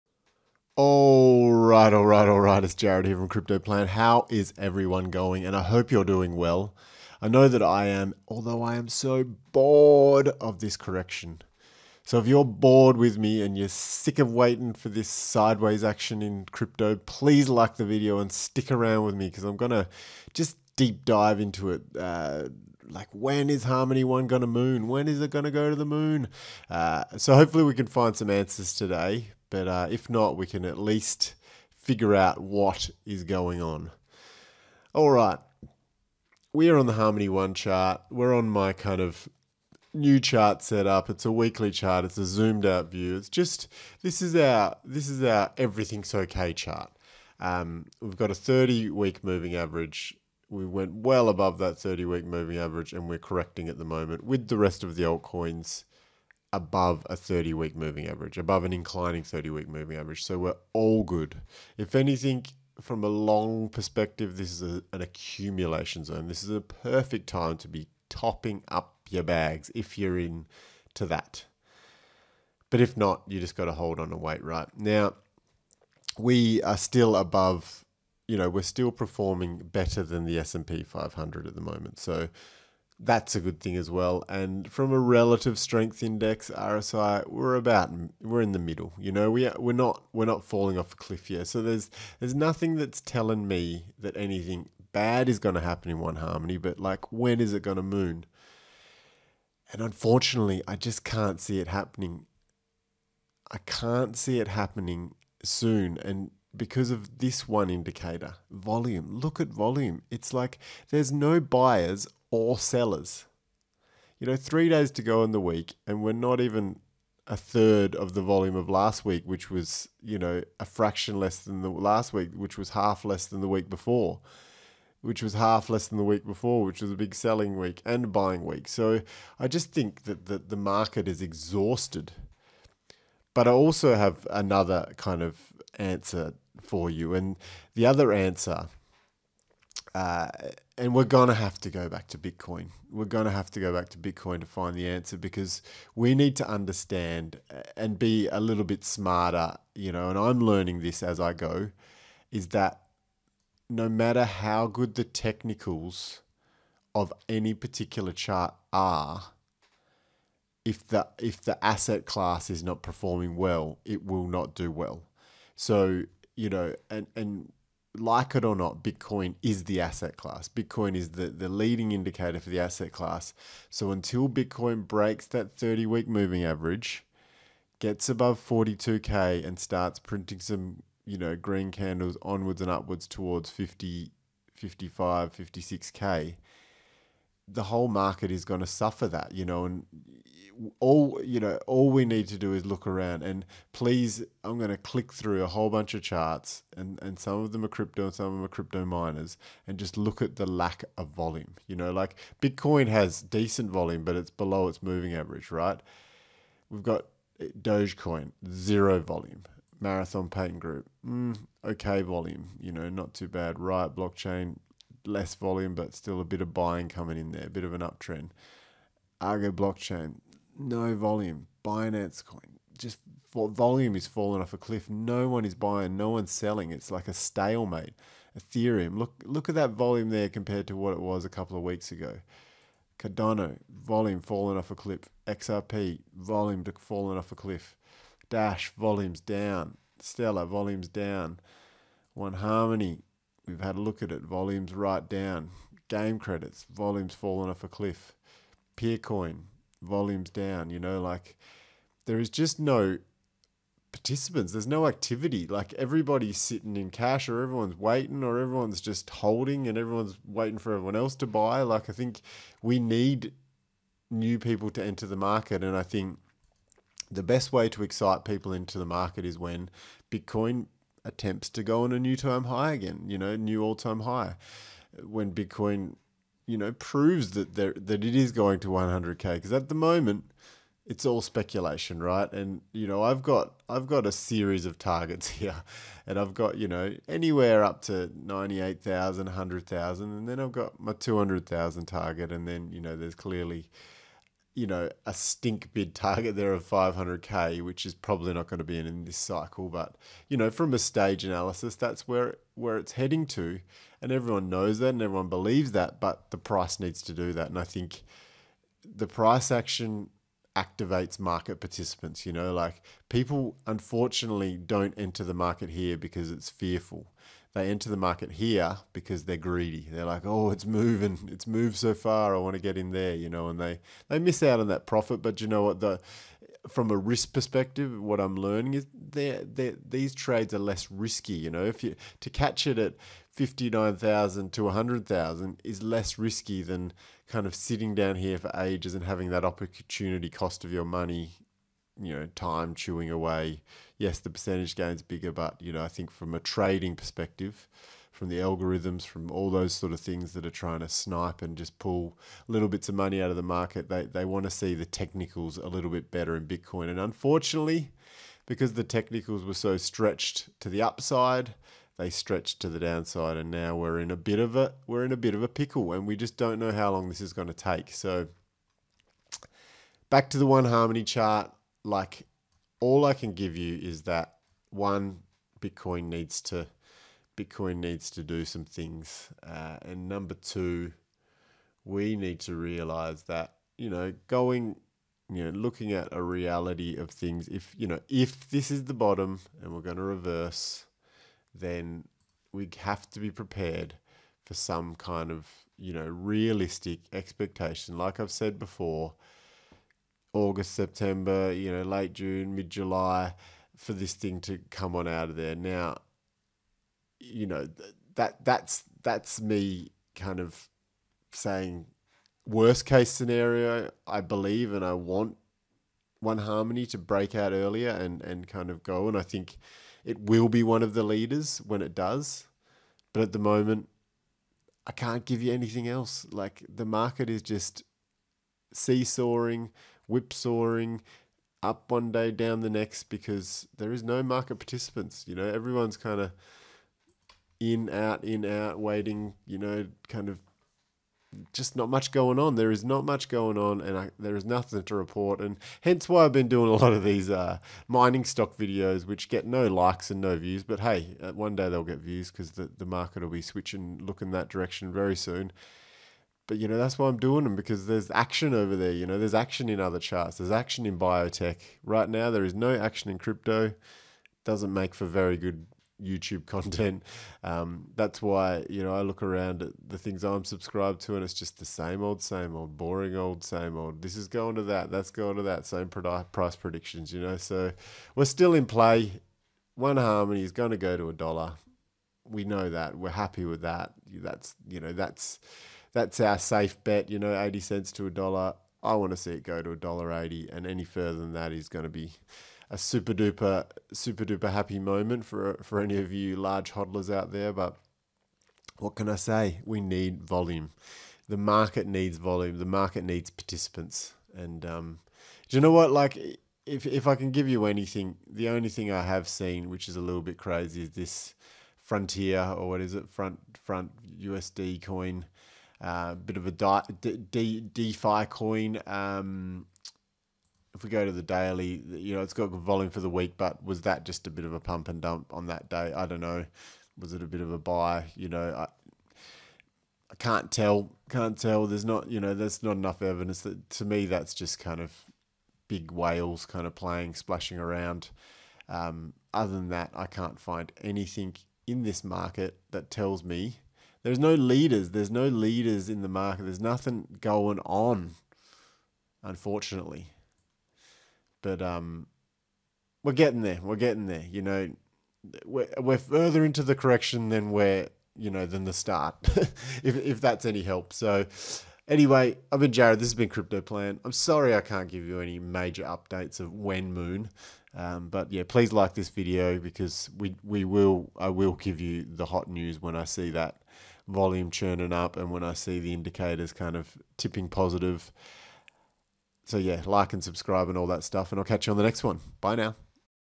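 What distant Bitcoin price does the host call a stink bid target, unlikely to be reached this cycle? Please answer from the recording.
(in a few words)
500k.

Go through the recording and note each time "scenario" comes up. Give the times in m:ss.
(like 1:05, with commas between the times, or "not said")
6:53.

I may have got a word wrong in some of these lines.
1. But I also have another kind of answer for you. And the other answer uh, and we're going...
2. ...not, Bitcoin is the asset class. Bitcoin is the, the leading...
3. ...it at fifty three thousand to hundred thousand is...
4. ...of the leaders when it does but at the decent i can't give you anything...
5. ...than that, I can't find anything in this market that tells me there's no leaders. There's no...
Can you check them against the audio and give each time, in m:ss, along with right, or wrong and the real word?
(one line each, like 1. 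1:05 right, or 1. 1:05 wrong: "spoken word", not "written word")
1. 2:13 right
2. 2:48 right
3. 5:32 wrong: "nine", not "three"
4. 7:00 wrong: "moment", not "decent"
5. 8:59 right.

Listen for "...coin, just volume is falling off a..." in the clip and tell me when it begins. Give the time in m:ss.
3:42.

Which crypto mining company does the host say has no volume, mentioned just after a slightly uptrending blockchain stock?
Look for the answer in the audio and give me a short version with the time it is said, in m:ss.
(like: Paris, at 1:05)
Argo Blockchain, at 3:39.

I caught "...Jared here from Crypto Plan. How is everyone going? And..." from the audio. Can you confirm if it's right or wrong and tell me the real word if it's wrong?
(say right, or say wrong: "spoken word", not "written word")
right.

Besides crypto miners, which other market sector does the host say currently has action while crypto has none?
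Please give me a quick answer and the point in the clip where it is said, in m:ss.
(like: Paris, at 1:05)
biotech, at 7:40.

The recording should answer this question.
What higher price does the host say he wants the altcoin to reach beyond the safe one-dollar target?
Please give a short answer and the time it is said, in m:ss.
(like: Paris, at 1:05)
$1.80, at 8:09.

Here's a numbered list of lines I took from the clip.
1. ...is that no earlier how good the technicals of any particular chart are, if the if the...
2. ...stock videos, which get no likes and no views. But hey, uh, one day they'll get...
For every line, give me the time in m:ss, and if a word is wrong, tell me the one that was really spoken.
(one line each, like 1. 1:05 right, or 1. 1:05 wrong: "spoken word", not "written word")
1. 2:32 wrong: "matter", not "earlier"
2. 7:28 right.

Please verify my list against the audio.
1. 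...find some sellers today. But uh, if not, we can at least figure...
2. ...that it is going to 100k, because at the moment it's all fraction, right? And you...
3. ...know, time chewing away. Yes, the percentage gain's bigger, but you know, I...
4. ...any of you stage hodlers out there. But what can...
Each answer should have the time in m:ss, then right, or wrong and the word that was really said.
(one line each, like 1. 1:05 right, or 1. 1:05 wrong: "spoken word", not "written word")
1. 0:27 wrong: "answers", not "sellers"
2. 4:37 wrong: "speculation", not "fraction"
3. 5:42 right
4. 8:15 wrong: "large", not "stage".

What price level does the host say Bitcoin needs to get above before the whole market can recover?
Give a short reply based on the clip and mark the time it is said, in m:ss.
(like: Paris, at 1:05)
42K, at 2:58.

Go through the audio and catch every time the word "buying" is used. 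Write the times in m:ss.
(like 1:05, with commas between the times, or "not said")
2:08, 3:36, 3:45.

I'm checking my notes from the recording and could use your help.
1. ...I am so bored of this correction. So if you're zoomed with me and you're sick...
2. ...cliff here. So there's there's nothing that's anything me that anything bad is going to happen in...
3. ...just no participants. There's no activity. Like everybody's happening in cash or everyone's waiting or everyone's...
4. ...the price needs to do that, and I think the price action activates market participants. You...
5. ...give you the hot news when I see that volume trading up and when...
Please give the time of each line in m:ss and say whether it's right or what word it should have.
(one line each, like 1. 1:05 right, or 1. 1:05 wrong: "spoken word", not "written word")
1. 0:08 wrong: "bored", not "zoomed"
2. 1:30 wrong: "telling", not "anything"
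3. 4:12 wrong: "sitting", not "happening"
4. 5:06 right
5. 9:31 wrong: "churning", not "trading".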